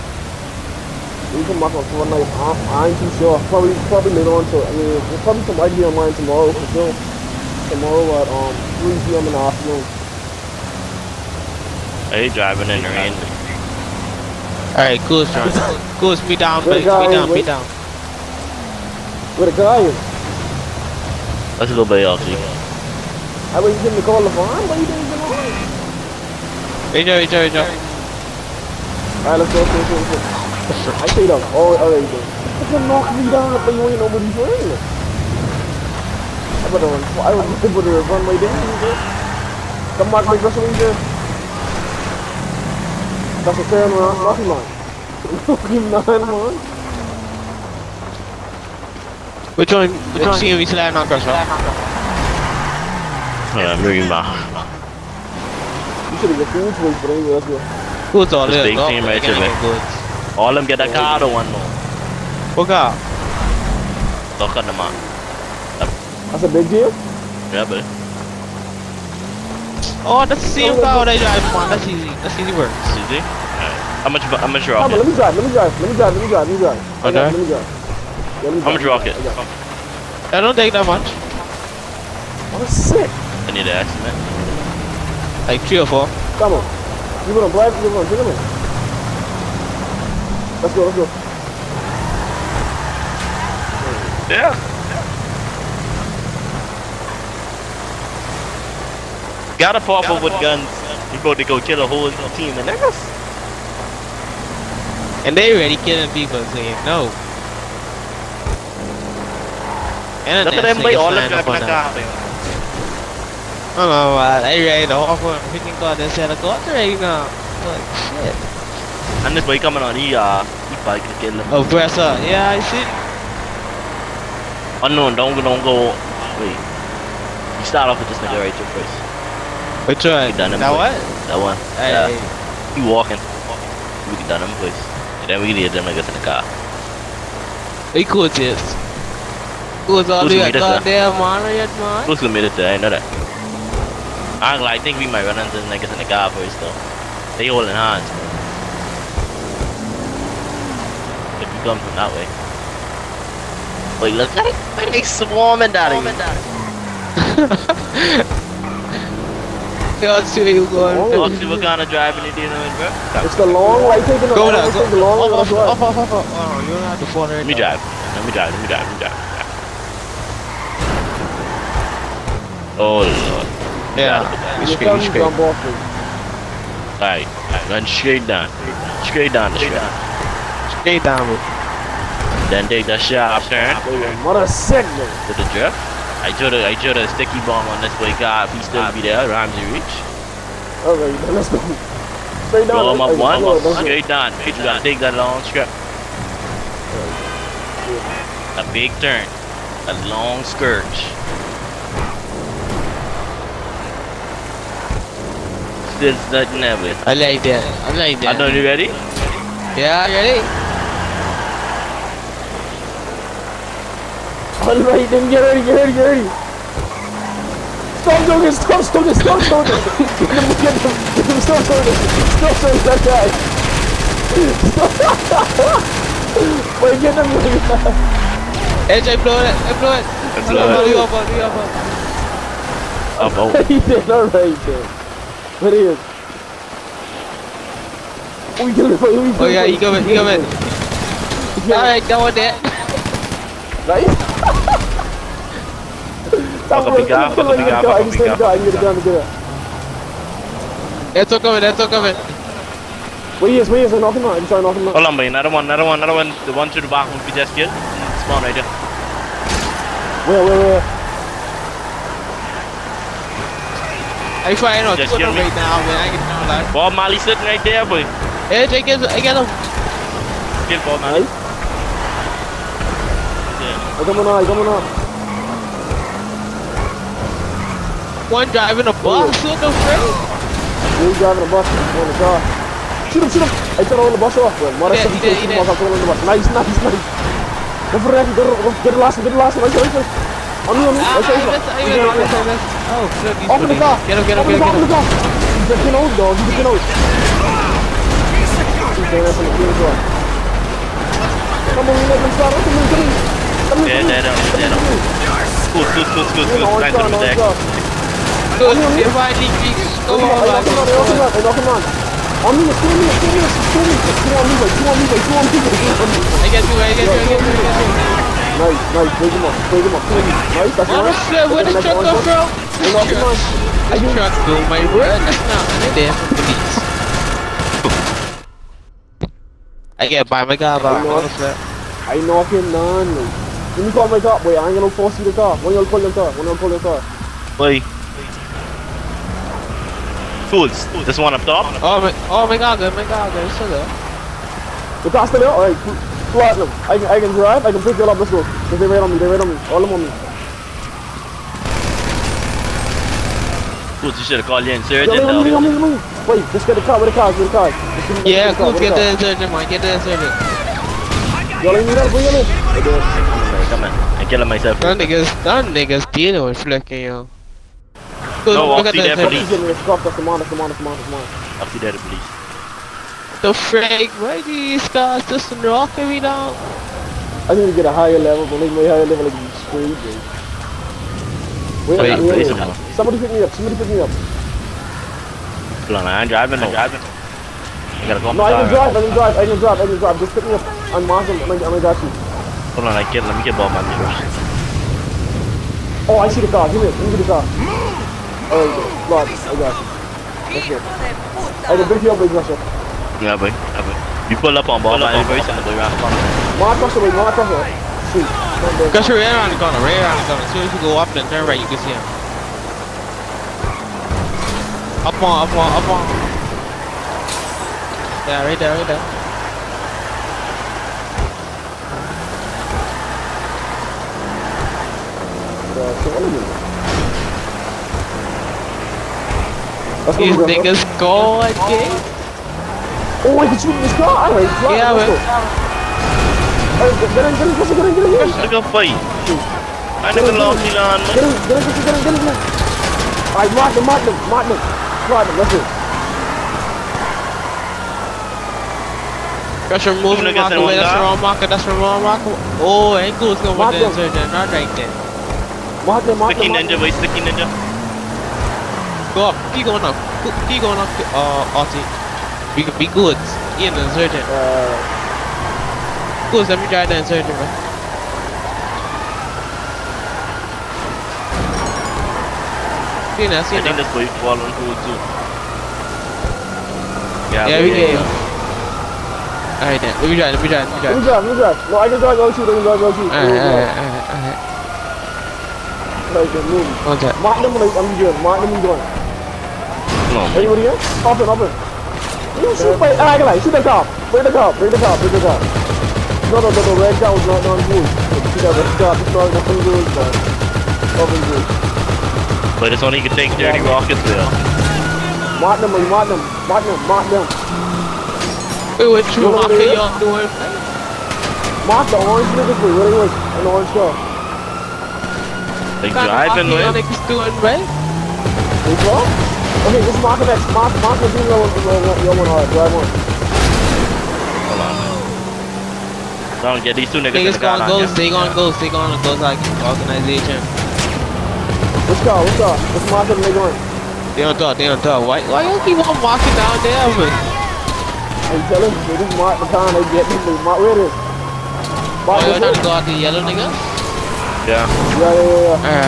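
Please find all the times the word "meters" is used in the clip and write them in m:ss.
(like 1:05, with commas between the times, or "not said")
6:33.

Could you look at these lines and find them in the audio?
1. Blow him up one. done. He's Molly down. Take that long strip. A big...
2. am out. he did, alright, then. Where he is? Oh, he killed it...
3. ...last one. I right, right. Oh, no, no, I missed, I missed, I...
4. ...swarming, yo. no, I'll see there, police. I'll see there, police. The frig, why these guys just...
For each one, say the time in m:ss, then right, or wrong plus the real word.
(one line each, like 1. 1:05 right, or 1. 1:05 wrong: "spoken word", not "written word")
1. 3:12 wrong: "Straight", not "Molly"
2. 3:53 right
3. 4:49 right
4. 6:06 wrong: "flicking", not "swarming".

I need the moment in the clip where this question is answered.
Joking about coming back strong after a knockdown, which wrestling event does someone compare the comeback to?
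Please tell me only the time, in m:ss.
0:40.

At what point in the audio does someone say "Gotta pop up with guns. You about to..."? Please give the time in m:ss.
1:39.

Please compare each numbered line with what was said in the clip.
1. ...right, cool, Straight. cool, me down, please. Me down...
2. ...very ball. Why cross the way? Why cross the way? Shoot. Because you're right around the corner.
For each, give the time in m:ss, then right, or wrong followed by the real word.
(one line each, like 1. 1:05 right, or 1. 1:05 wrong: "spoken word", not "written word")
1. 0:14 wrong: "Sean", not "Straight"
2. 6:45 right.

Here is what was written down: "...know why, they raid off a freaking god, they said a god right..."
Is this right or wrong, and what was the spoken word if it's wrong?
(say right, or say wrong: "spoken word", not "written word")
right.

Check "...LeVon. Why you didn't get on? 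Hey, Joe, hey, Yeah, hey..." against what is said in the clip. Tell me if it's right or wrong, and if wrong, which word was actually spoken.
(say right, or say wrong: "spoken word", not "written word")
wrong: "Joe", not "Yeah".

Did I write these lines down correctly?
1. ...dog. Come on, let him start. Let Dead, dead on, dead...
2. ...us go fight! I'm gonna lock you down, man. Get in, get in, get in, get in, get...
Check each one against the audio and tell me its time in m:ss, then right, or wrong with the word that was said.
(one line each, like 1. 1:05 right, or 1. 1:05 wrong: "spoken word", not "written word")
1. 4:59 right
2. 7:18 right.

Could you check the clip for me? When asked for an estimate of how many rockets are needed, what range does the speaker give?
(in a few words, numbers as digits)
Three or four.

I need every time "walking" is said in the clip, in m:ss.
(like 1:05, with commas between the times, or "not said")
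2:12, 8:56.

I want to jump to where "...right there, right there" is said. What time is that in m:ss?
6:58.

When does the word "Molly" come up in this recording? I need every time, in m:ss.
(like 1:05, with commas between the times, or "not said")
4:26, 4:31.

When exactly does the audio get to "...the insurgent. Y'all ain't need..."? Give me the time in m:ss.
5:59.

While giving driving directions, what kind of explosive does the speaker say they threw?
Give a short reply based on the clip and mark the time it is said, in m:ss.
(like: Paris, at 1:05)
Sticky bomb, at 3:07.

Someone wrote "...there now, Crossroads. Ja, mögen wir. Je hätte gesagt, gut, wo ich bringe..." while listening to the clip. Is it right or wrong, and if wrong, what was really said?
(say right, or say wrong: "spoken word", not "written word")
right.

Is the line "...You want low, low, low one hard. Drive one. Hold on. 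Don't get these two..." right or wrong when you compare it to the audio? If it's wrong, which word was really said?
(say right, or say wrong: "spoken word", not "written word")
right.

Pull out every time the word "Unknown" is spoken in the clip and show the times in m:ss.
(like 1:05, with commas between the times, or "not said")
2:04.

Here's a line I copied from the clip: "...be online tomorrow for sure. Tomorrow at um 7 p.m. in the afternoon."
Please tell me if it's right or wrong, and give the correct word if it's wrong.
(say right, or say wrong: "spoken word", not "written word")
wrong: "3", not "7".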